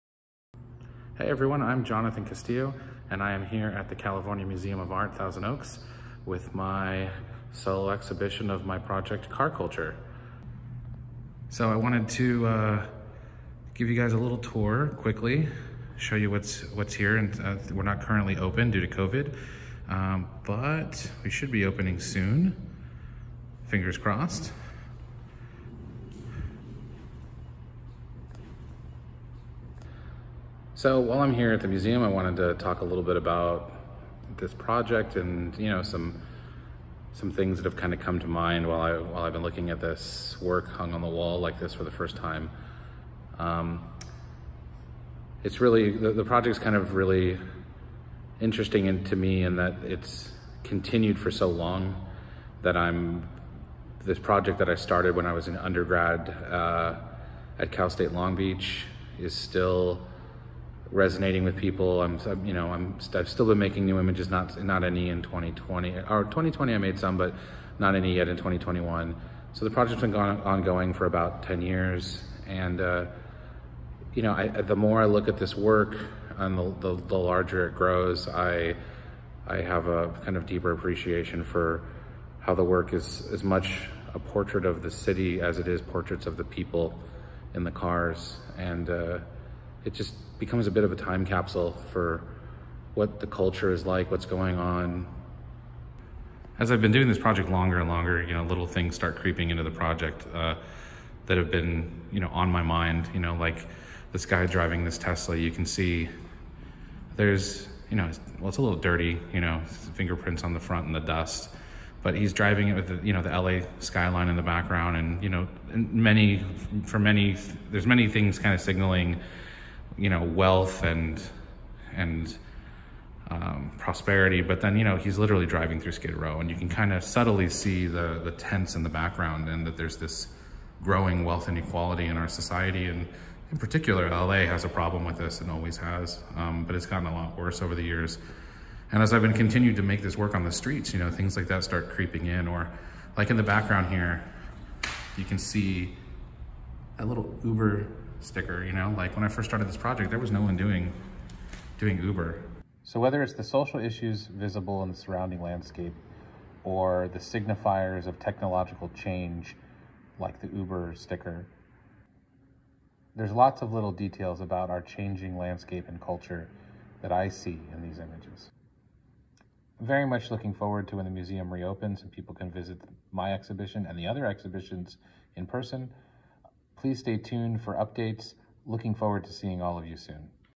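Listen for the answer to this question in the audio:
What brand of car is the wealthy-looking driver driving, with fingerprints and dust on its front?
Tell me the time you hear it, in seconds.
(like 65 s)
104 s.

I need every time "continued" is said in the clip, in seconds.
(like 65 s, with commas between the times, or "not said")
50 s, 139 s.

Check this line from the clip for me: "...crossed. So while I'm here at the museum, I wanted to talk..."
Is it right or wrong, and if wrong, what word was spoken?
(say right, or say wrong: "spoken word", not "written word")
right.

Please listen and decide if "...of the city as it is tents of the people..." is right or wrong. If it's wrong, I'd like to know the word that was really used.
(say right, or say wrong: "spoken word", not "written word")
wrong: "portraits", not "tents".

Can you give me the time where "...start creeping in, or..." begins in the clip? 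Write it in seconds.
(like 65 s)
141 s.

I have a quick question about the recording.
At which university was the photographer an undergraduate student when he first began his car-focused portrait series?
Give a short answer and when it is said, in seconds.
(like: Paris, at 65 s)
Cal State Long Beach, at 57 s.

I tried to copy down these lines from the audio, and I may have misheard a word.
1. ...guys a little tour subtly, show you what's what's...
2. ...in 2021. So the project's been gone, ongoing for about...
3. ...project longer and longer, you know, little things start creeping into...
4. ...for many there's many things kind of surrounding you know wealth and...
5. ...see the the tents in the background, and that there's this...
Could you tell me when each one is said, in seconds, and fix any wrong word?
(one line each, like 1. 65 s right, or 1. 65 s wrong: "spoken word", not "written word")
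1. 13 s wrong: "quickly", not "subtly"
2. 68 s right
3. 97 s right
4. 116 s wrong: "signaling", not "surrounding"
5. 127 s right.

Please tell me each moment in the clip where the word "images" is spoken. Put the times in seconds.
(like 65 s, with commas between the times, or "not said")
63 s, 167 s.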